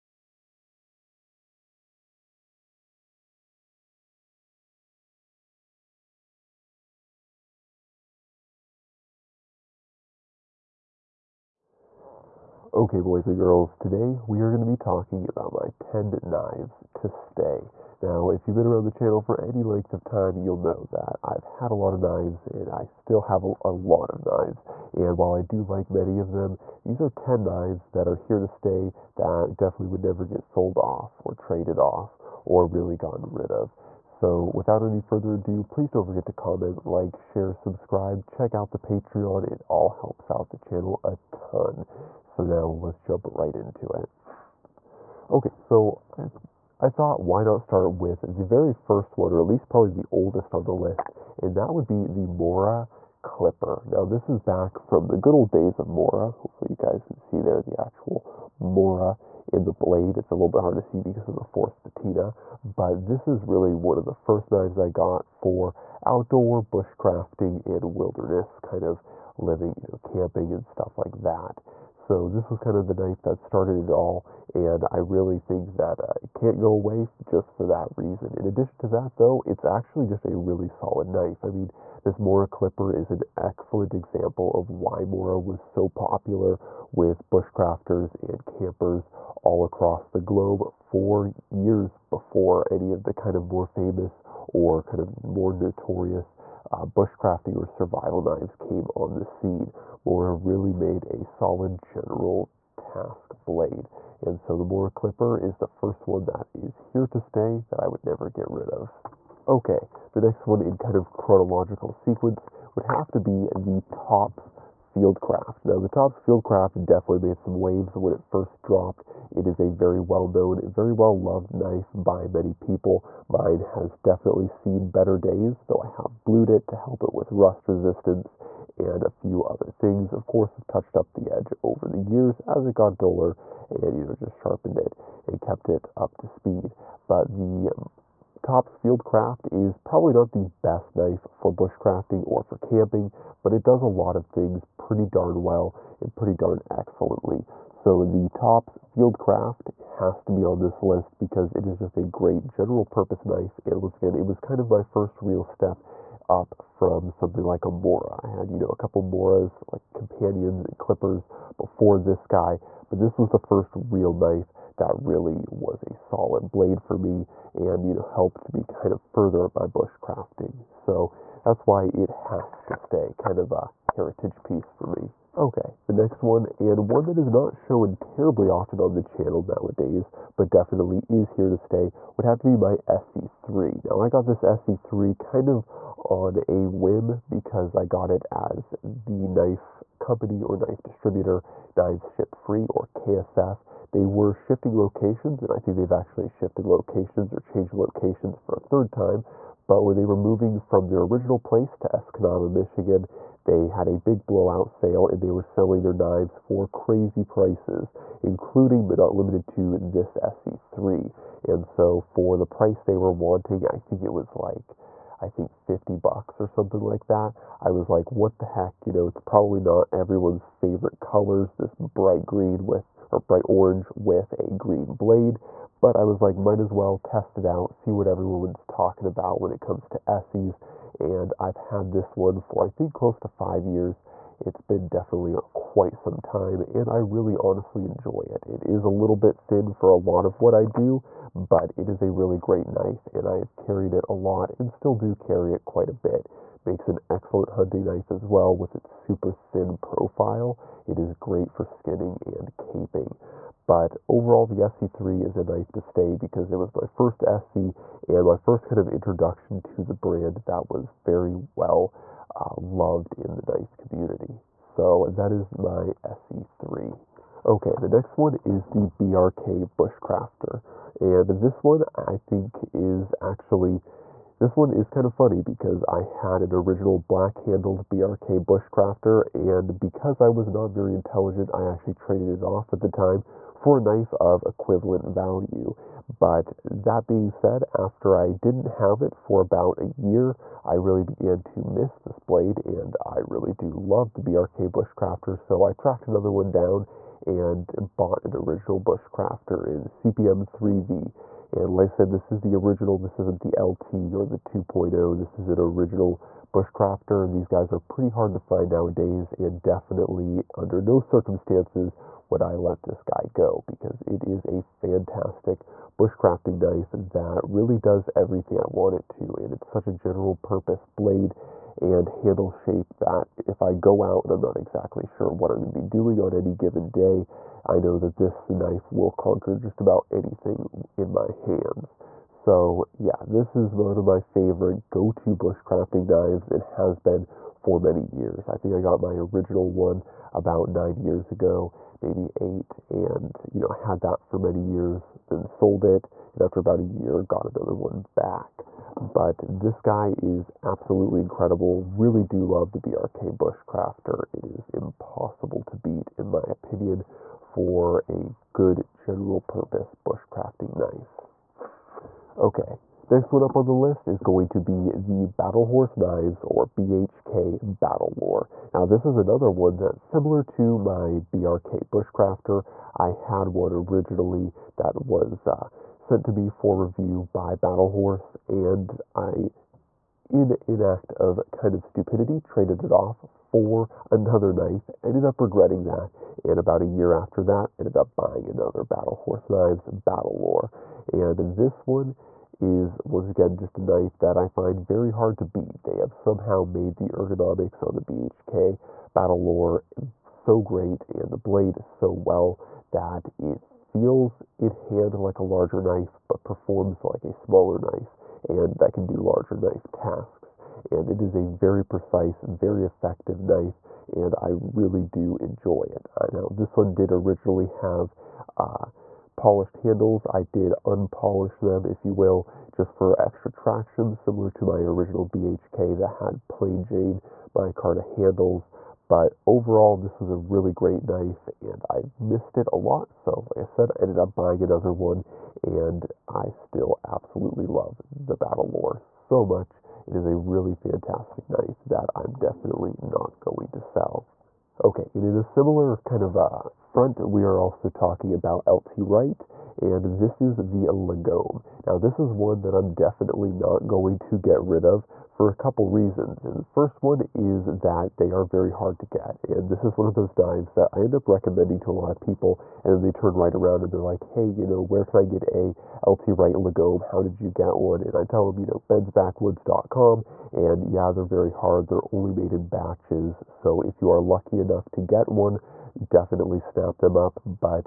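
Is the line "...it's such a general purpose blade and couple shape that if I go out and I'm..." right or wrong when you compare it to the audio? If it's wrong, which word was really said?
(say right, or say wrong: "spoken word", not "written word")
wrong: "handle", not "couple".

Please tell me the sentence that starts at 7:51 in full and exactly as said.
They're only made in batches, so if you are lucky enough, enough to get one, definitely snap them up.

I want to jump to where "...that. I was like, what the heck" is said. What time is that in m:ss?
3:37.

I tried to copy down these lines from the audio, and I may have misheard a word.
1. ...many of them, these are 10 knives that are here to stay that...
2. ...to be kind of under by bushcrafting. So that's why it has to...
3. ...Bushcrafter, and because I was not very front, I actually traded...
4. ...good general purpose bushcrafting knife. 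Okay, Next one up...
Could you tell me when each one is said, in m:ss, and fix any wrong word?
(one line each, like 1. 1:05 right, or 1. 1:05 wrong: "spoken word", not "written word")
1. 0:25 right
2. 2:48 wrong: "further", not "under"
3. 4:38 wrong: "intelligent", not "front"
4. 5:58 right.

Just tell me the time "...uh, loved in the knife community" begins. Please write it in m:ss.
4:22.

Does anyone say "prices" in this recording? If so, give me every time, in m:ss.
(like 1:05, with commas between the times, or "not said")
3:27, 3:32.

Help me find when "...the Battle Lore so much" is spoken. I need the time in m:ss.
7:18.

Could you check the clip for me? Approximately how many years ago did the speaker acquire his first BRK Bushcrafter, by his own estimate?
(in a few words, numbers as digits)
9 years.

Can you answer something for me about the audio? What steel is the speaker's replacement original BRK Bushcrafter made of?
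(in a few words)
CPM 3V.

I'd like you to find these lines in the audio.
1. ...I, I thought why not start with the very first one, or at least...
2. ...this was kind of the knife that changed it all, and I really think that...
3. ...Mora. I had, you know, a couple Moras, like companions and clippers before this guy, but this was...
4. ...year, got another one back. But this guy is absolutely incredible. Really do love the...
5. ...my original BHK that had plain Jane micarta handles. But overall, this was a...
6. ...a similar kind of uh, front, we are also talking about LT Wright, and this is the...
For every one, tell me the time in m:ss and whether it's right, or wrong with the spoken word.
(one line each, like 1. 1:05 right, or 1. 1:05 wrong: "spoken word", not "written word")
1. 0:46 right
2. 1:12 wrong: "started", not "changed"
3. 2:37 right
4. 5:46 right
5. 7:04 right
6. 7:25 right.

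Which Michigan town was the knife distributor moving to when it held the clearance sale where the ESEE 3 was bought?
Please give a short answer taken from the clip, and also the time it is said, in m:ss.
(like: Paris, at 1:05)
Escanaba, at 3:21.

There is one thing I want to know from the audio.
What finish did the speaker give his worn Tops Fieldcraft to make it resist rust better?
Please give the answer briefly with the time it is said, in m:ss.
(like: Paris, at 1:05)
Blued, at 2:06.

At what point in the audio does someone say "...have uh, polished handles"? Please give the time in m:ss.
6:57.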